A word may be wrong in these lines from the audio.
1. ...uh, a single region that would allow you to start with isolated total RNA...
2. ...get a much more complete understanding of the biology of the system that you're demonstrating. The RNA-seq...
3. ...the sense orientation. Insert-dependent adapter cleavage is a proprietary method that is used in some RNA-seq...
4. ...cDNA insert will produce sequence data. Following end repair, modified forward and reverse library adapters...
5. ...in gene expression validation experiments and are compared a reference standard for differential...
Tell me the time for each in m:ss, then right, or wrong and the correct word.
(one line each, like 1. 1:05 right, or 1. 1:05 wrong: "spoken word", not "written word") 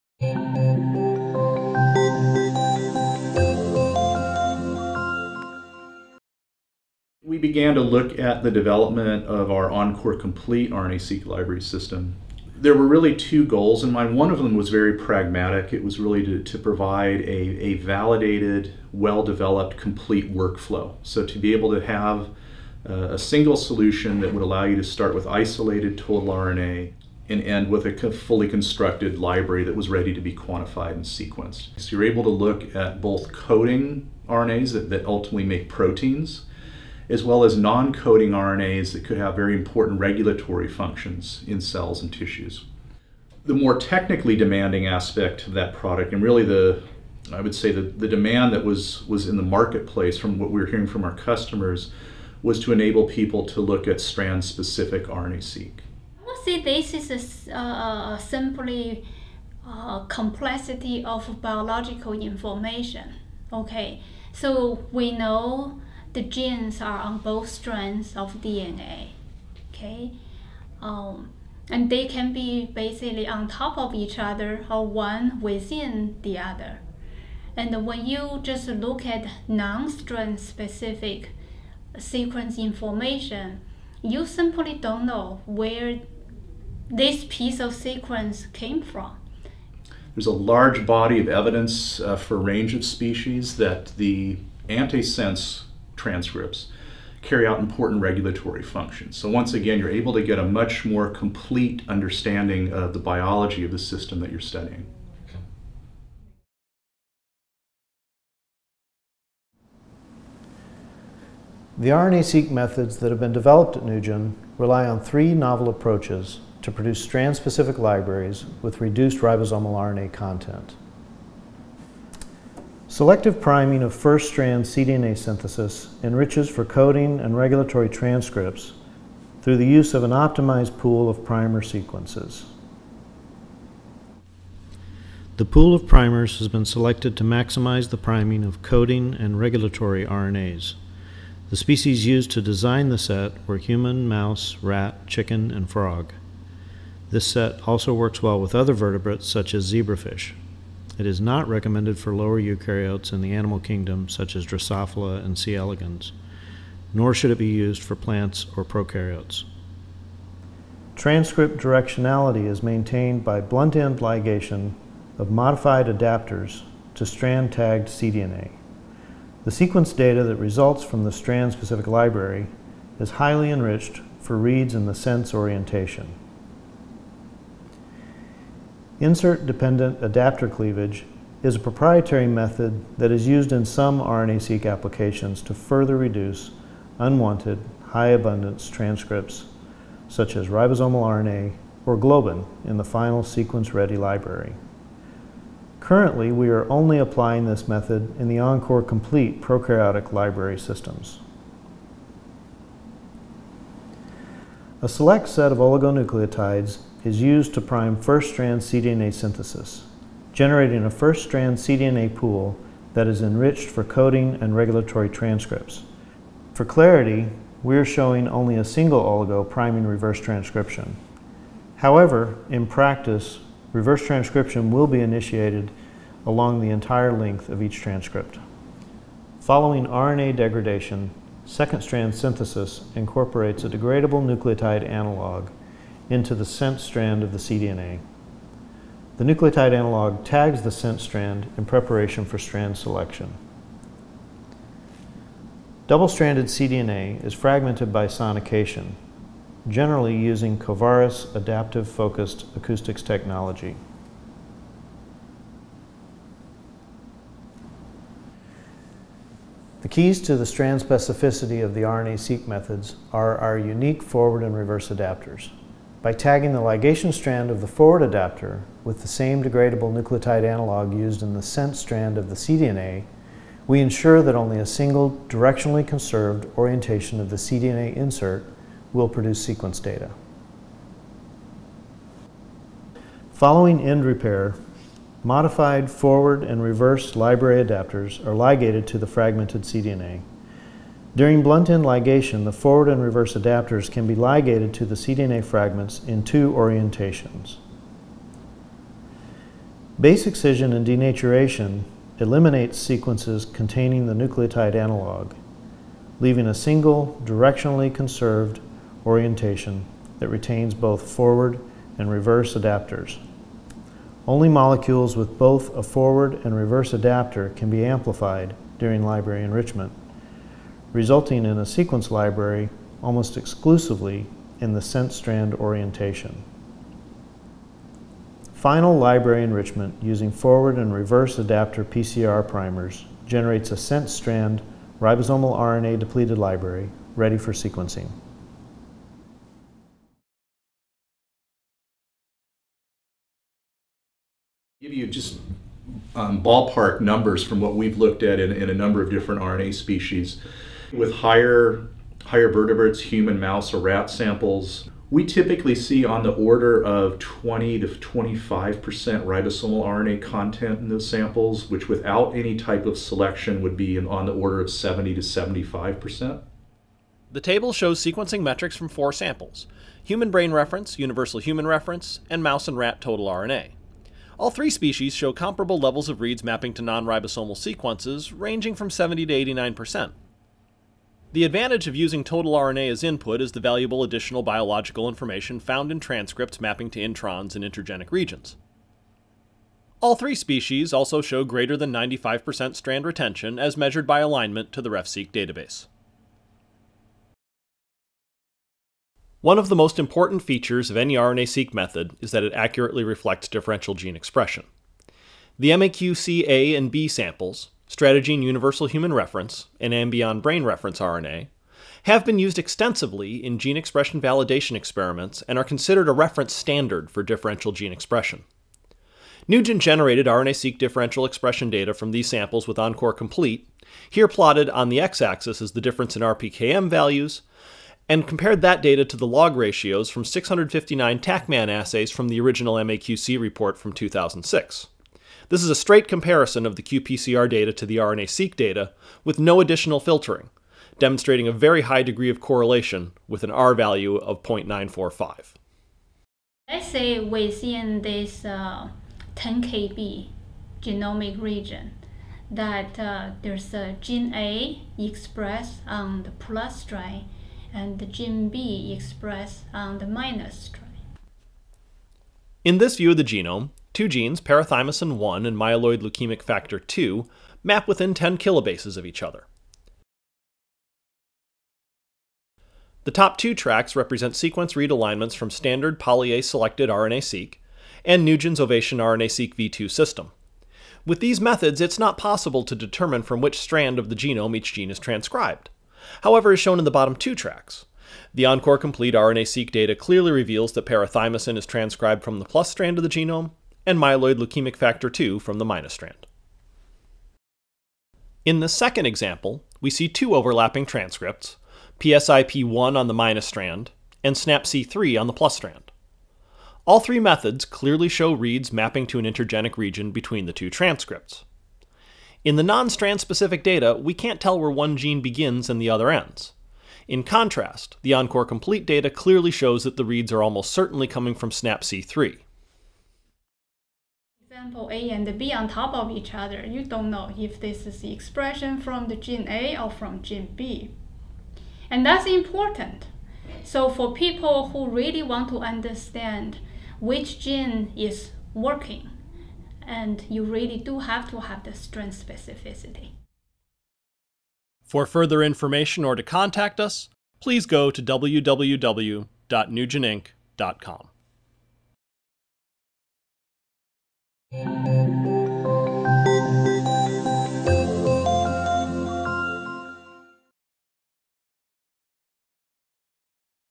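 1. 0:22 wrong: "solution", not "region"
2. 1:40 wrong: "studying", not "demonstrating"
3. 2:54 right
4. 4:37 right
5. 6:53 wrong: "considered", not "compared".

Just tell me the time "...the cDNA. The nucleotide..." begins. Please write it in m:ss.
3:57.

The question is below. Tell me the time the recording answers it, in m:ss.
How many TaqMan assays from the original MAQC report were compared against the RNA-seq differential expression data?
7:10.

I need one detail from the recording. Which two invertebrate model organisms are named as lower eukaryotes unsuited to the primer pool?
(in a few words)
Drosophila and C. elegans.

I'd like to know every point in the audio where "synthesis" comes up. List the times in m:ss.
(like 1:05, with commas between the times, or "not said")
2:05, 3:29, 3:52.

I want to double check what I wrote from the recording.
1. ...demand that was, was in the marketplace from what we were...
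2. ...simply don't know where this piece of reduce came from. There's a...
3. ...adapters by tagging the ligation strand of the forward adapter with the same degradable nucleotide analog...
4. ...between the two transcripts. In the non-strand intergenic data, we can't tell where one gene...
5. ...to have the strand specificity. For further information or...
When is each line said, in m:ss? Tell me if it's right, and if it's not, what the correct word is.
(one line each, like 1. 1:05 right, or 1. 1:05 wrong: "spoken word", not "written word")
1. 0:48 right
2. 1:24 wrong: "sequence", not "reduce"
3. 4:24 right
4. 8:30 wrong: "specific", not "intergenic"
5. 9:01 right.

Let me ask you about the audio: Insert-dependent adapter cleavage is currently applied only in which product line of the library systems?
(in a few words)
Encore Complete prokaryotic.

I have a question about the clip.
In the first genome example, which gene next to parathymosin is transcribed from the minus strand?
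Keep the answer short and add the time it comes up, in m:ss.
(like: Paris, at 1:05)
myeloid leukemic factor 2, at 7:45.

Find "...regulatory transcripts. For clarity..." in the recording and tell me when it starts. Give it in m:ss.
3:34.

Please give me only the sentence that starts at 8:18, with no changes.
In the second example, we see two overlapping transcripts, PSIP1 on the minus strand and SNAPC3 on the plus strand.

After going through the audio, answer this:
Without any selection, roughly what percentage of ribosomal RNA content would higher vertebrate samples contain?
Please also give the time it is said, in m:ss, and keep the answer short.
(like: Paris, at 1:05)
70 to 75 percent, at 6:04.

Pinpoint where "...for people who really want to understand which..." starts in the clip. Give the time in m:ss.
8:53.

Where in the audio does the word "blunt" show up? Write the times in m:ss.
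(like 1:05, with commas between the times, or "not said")
2:43, 4:51.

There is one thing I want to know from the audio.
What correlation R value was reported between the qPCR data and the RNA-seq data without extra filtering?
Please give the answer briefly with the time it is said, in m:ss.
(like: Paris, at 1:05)
0.945, at 7:24.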